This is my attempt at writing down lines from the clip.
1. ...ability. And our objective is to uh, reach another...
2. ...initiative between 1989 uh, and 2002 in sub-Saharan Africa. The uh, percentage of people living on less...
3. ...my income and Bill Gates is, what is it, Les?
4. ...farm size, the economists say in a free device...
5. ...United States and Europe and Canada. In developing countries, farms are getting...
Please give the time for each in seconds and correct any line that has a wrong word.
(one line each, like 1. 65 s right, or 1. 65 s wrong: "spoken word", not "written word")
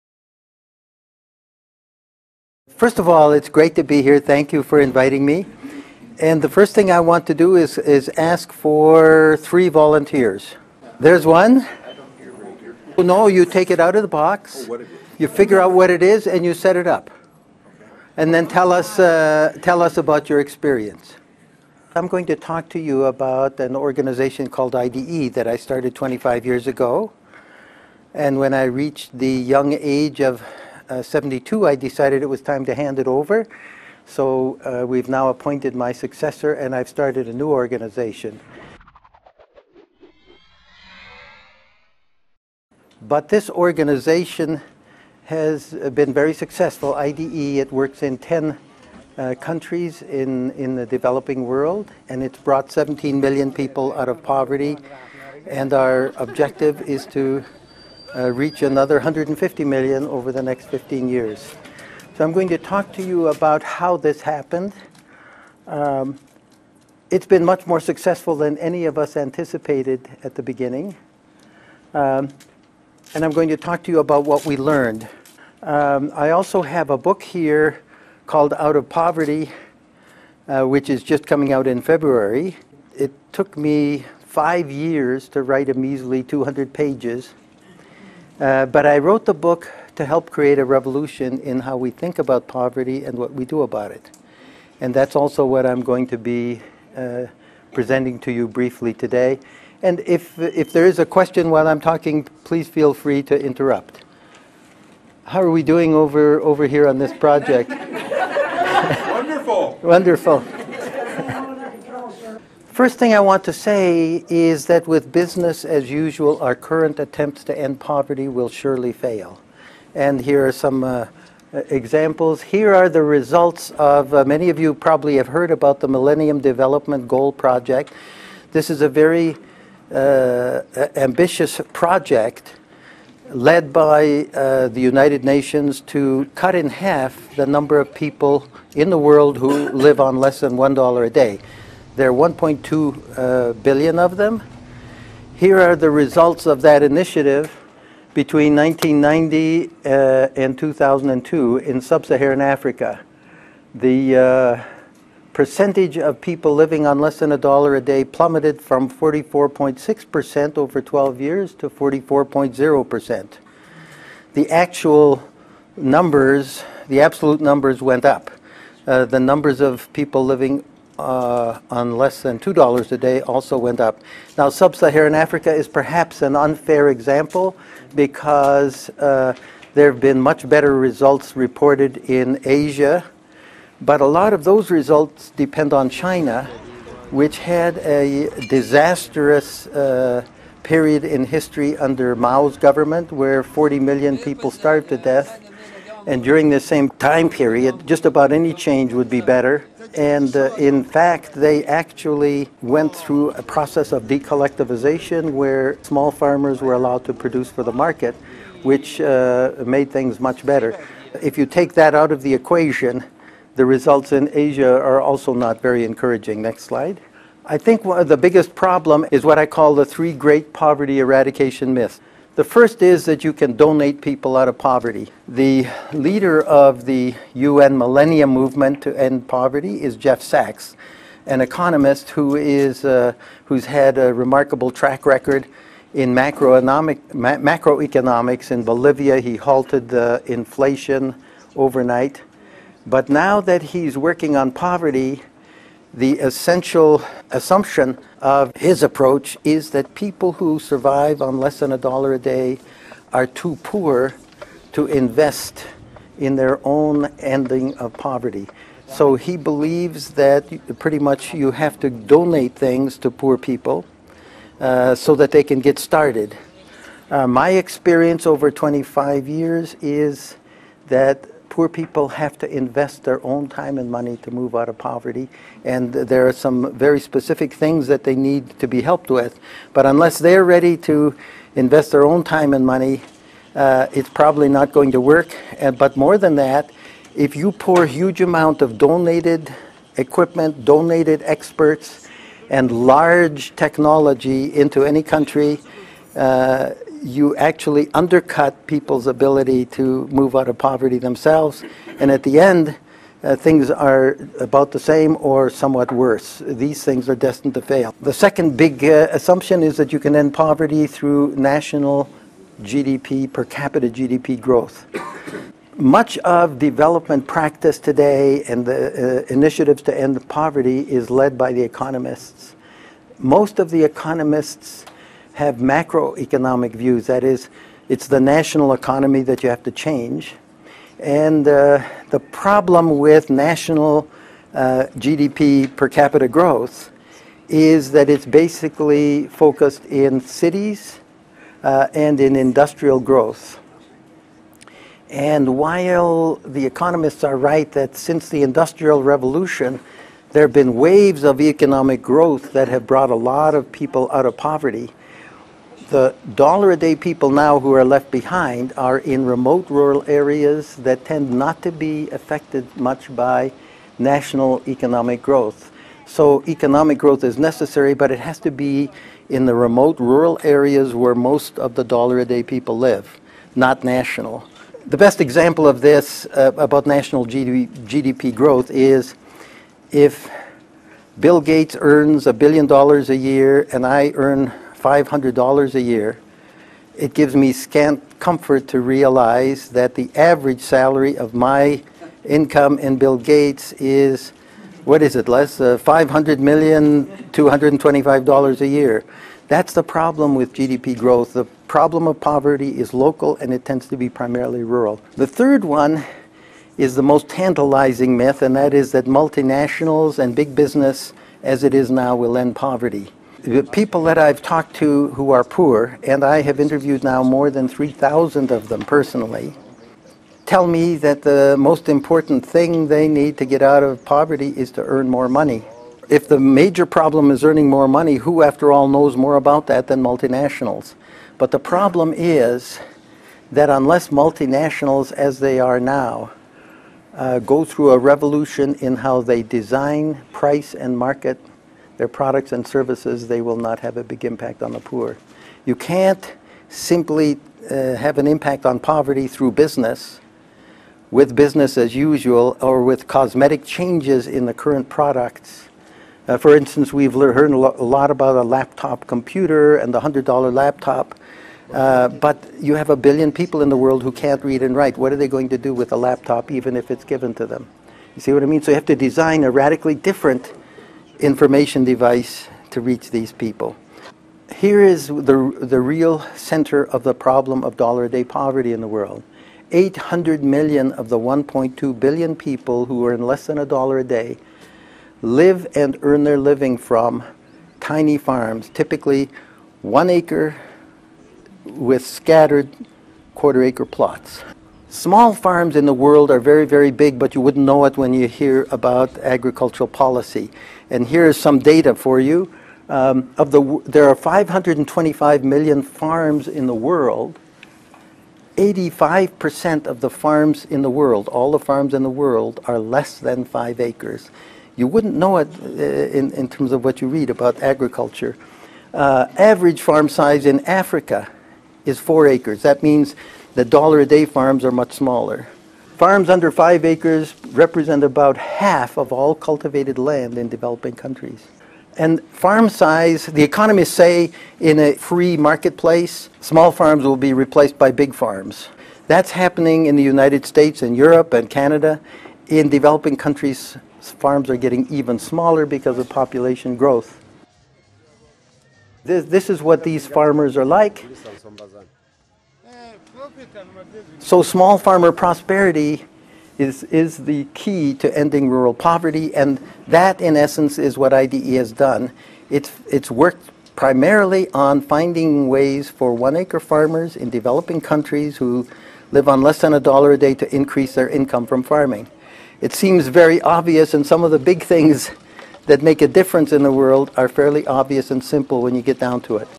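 1. 54 s wrong: "poverty", not "ability"
2. 146 s wrong: "1990", not "1989"
3. 391 s right
4. 532 s wrong: "marketplace", not "device"
5. 540 s right.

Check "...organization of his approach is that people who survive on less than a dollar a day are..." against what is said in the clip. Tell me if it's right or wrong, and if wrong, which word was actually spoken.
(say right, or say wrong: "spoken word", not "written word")
wrong: "assumption", not "organization".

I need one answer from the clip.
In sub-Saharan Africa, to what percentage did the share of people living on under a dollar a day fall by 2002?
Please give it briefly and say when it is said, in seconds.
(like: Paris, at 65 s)
44.0%, at 161 s.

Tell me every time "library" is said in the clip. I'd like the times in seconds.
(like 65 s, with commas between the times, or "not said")
not said.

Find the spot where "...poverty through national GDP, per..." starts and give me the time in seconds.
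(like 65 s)
310 s.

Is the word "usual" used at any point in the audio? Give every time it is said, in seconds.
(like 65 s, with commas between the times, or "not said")
115 s, 451 s.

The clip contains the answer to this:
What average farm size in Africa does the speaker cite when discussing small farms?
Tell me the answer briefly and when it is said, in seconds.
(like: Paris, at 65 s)
4 acres, at 521 s.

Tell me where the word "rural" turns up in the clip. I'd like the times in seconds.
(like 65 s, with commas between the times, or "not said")
359 s, 369 s, 404 s, 558 s.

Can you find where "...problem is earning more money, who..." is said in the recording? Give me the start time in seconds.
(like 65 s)
426 s.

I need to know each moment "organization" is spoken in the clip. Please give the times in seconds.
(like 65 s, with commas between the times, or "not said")
23 s, 37 s, 43 s.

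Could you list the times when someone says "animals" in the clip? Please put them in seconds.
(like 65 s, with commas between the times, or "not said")
not said.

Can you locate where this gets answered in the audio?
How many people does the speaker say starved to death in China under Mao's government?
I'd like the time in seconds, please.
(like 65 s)
193 s.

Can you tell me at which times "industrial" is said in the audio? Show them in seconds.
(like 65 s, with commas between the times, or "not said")
342 s, 348 s.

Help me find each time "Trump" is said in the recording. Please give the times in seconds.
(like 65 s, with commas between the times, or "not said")
not said.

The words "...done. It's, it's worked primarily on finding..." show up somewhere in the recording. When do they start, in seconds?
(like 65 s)
561 s.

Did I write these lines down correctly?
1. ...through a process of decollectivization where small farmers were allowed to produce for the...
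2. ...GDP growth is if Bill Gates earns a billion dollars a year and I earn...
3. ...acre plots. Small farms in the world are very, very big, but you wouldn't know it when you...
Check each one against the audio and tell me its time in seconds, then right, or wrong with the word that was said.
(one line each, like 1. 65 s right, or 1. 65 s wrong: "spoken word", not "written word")
1. 202 s right
2. 377 s right
3. 493 s right.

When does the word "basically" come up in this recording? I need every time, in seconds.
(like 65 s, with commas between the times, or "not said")
338 s.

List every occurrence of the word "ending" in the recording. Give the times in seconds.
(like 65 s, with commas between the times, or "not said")
257 s, 558 s.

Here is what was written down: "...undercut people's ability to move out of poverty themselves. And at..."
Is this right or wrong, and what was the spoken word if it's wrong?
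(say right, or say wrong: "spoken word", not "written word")
right.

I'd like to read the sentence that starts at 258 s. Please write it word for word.
So he believes that pretty much you have to donate things to poor people uh, so that they can get started.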